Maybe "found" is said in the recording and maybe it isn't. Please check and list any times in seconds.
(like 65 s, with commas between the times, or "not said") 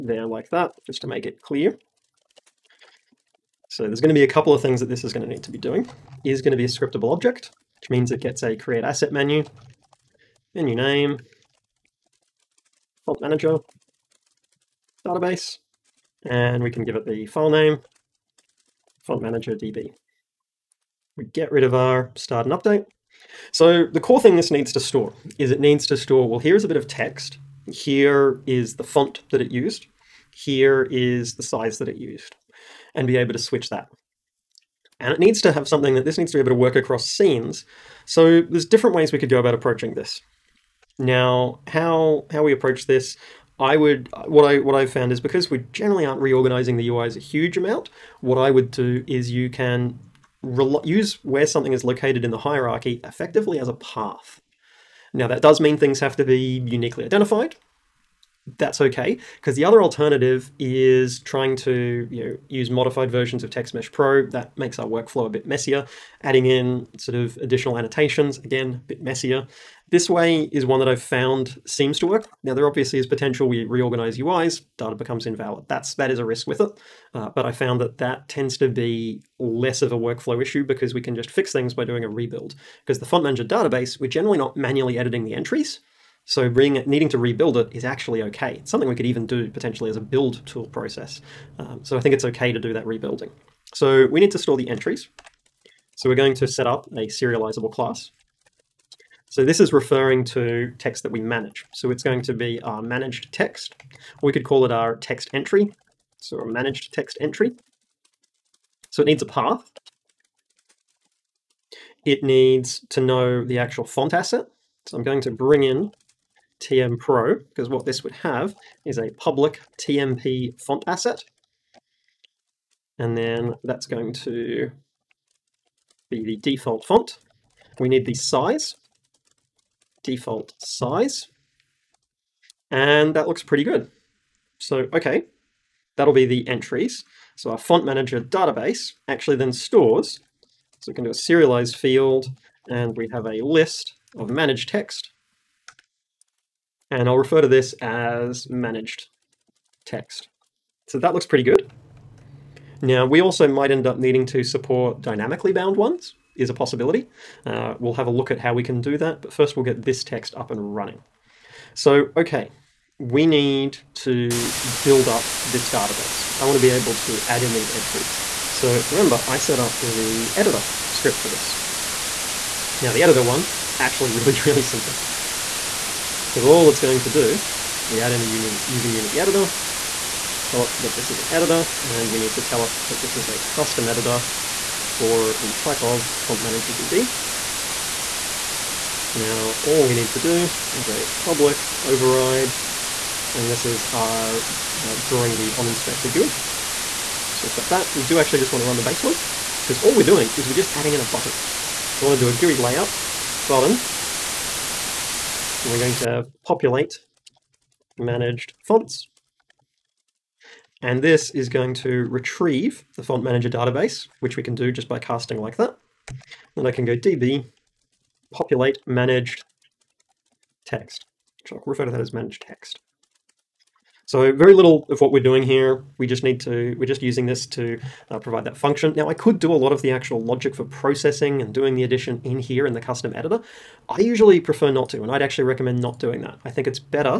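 44 s, 71 s, 77 s.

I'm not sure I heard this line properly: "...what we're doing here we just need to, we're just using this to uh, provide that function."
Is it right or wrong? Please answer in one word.
right.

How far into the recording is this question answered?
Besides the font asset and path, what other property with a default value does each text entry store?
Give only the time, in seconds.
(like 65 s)
130 s.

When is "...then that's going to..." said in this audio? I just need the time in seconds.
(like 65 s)
123 s.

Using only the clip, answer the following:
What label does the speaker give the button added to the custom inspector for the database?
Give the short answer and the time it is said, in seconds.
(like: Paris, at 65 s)
populate managed fonts, at 206 s.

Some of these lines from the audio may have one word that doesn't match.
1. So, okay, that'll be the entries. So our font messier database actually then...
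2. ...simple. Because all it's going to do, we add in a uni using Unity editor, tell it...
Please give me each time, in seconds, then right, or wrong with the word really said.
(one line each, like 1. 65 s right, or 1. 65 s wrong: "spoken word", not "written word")
1. 134 s wrong: "manager", not "messier"
2. 174 s right.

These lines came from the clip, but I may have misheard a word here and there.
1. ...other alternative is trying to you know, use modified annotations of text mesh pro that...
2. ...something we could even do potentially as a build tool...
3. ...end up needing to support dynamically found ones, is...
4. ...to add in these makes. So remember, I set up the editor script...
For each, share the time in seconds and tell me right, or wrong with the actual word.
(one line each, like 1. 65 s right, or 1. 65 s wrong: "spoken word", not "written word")
1. 59 s wrong: "versions", not "annotations"
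2. 88 s right
3. 153 s wrong: "bound", not "found"
4. 166 s wrong: "entries", not "makes".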